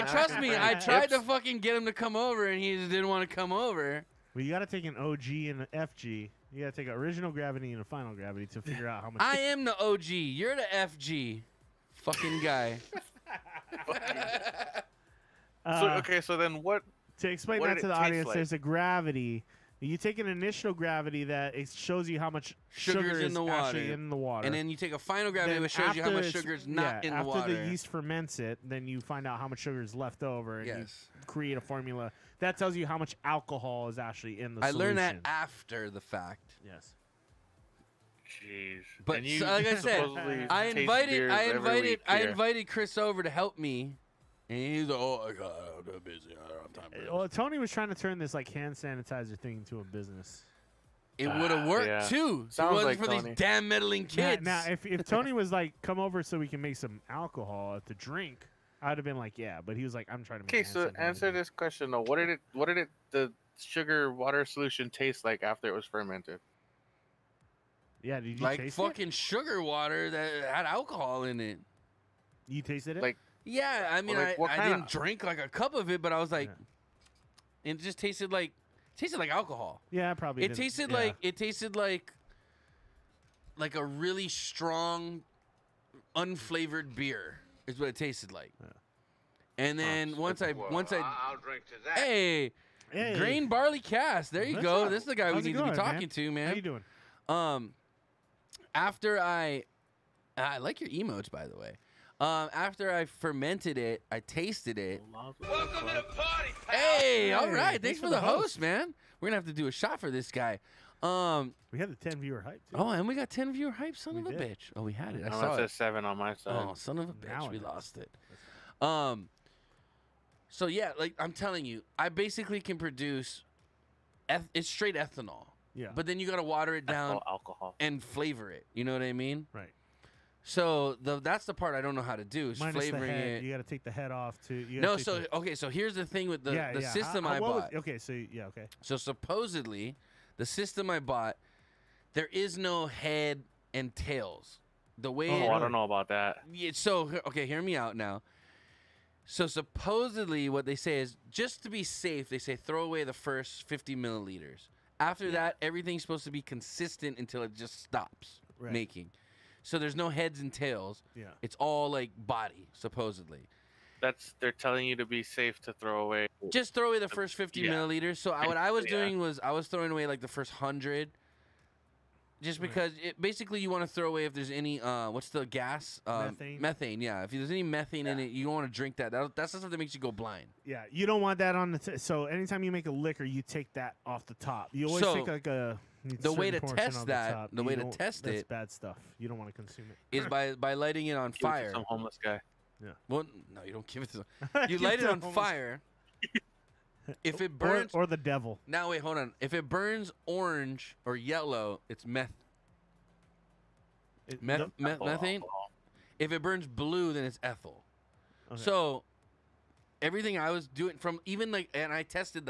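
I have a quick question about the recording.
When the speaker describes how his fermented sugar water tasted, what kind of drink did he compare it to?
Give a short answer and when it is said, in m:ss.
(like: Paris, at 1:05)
really strong, unflavored beer, at 1:23.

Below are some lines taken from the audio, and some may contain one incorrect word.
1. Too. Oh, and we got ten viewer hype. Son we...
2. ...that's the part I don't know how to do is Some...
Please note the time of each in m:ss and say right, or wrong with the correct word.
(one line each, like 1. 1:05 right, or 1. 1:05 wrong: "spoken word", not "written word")
1. 1:52 right
2. 2:11 wrong: "Minus", not "Some".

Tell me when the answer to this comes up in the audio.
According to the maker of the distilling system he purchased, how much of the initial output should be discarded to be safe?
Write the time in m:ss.
2:33.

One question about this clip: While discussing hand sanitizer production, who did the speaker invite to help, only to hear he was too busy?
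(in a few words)
Chris.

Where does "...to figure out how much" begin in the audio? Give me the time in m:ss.
0:08.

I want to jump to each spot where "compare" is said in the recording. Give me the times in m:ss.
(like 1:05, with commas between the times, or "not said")
not said.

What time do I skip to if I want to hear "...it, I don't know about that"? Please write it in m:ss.
2:25.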